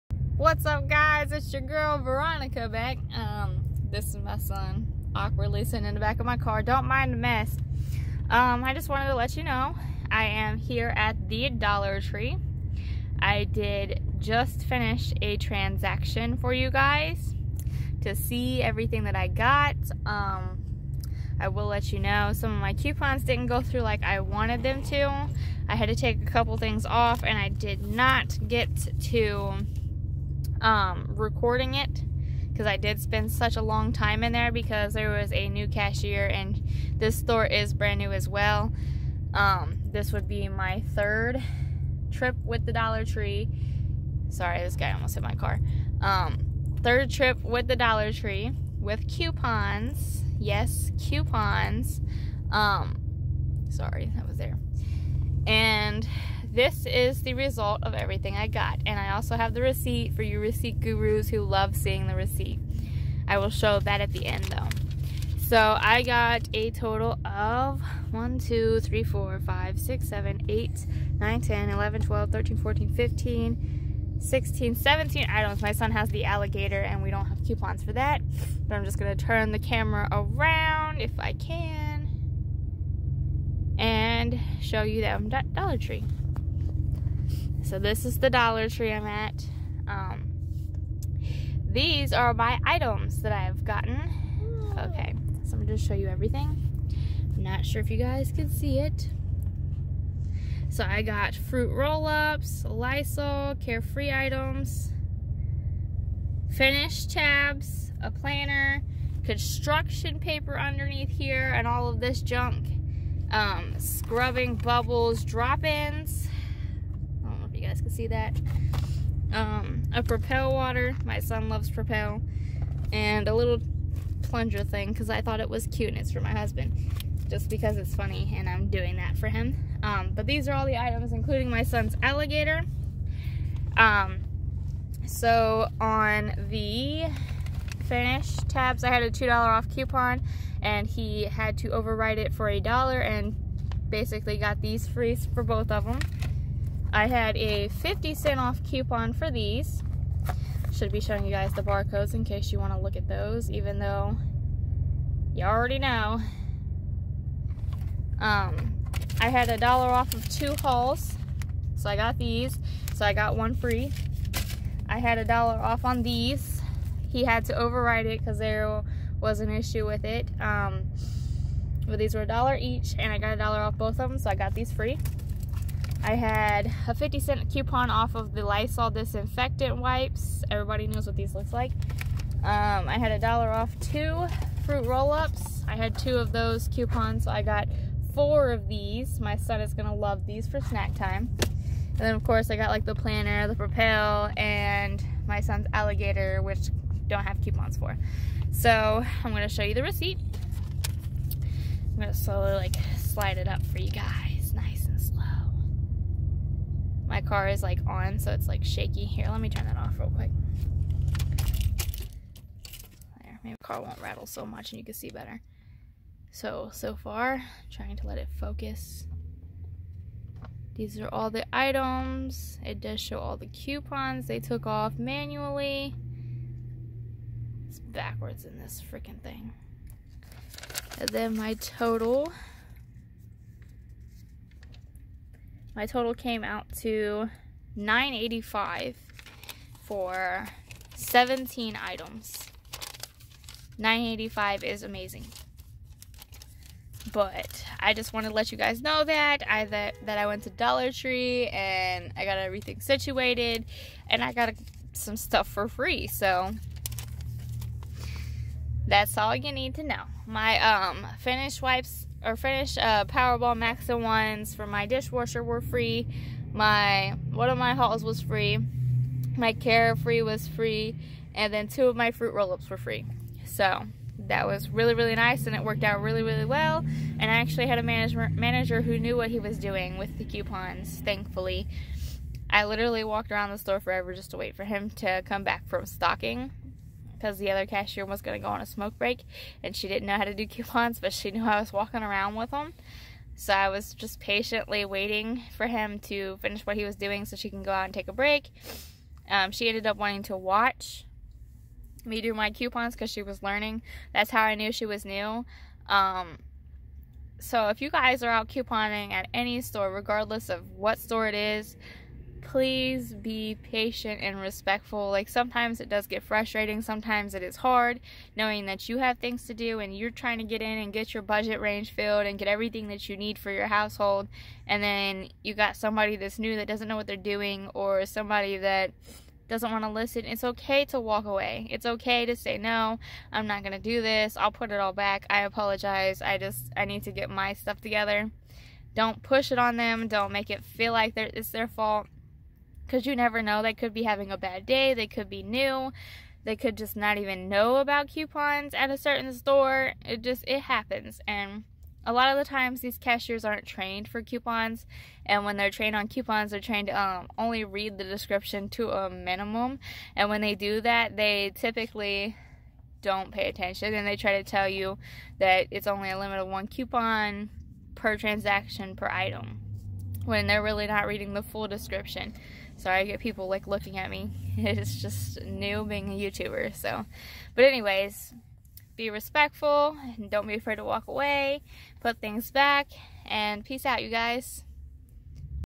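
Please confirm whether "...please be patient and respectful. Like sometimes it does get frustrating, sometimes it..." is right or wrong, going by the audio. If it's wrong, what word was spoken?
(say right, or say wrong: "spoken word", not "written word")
right.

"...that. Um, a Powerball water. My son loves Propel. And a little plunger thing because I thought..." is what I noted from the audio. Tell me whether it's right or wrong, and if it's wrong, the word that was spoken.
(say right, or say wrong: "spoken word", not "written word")
wrong: "Propel", not "Powerball".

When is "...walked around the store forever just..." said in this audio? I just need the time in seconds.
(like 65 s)
283 s.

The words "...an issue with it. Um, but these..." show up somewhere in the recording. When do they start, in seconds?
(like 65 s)
169 s.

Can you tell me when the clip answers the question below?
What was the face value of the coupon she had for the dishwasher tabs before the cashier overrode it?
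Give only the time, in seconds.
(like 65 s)
139 s.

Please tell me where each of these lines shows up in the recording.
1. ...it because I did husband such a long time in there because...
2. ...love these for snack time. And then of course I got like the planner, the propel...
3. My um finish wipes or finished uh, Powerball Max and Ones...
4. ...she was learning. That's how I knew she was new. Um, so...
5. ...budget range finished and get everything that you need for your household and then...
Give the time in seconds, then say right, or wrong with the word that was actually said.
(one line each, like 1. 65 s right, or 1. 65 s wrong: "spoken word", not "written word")
1. 31 s wrong: "spend", not "husband"
2. 189 s right
3. 260 s right
4. 303 s right
5. 321 s wrong: "filled", not "finished".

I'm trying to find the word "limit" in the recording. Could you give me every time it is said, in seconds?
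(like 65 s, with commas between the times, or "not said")
366 s.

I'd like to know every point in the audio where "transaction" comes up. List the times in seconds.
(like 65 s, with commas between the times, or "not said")
15 s, 368 s.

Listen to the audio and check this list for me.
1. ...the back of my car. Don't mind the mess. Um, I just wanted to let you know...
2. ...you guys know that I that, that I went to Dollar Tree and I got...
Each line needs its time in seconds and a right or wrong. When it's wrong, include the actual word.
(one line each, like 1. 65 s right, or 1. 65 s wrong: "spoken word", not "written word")
1. 5 s right
2. 248 s right.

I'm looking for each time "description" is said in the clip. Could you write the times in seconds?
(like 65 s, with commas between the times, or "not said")
358 s, 371 s.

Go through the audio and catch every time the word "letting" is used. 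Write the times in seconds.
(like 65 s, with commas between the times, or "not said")
not said.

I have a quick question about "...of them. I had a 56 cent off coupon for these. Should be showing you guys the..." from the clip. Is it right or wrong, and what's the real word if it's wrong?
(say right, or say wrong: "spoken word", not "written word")
wrong: "50", not "56".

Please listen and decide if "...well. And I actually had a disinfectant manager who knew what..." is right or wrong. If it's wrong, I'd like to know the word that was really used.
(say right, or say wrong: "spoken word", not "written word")
wrong: "management", not "disinfectant".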